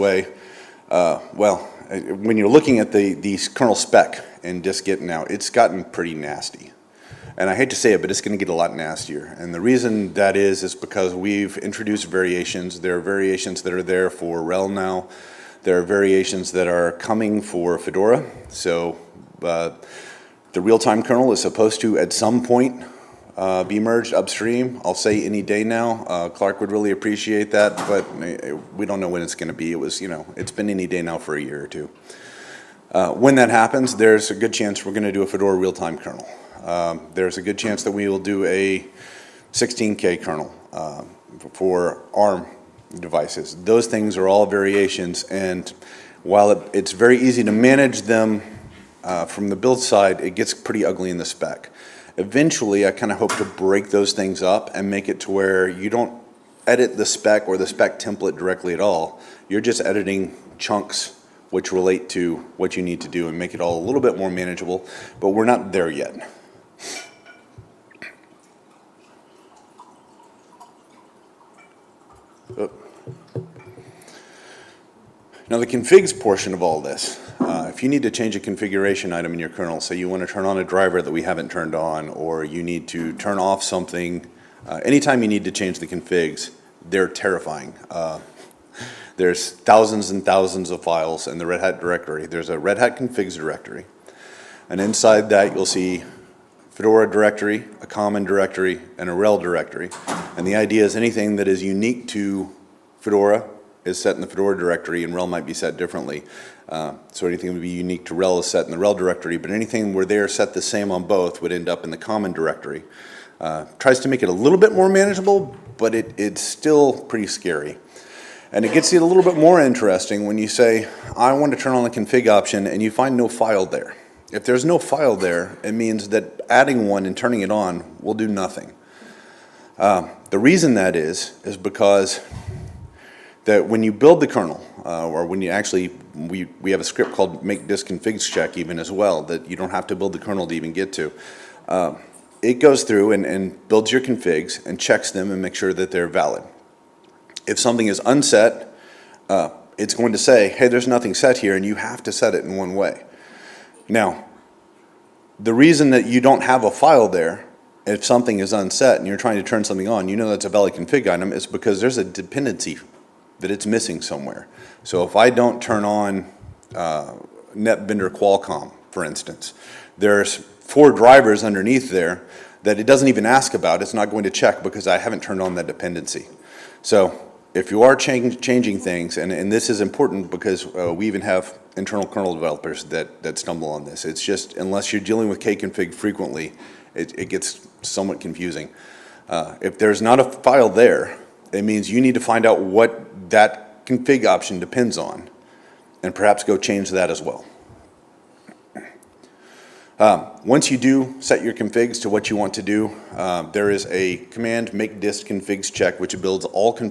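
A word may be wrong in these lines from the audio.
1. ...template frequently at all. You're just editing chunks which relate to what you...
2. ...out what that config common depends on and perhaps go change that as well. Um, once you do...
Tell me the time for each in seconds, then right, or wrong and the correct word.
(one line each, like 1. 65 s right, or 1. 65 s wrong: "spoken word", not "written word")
1. 57 s wrong: "directly", not "frequently"
2. 192 s wrong: "option", not "common".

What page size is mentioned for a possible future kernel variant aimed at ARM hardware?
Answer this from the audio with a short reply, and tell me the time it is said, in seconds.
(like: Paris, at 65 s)
16K, at 39 s.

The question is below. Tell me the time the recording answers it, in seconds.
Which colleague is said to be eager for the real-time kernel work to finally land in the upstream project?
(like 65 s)
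26 s.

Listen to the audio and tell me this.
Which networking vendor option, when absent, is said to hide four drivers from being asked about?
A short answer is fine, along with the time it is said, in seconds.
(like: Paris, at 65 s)
NetVendor Qualcomm, at 167 s.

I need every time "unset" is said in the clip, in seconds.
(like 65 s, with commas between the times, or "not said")
148 s, 158 s.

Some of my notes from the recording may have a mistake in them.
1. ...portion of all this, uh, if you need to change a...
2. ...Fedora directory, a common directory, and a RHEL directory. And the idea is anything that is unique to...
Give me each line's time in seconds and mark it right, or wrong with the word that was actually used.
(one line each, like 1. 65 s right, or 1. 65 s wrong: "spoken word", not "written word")
1. 76 s right
2. 96 s right.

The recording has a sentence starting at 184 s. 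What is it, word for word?
It's just, unless you're dealing with kconfig frequently, it, it gets somewhat confusing.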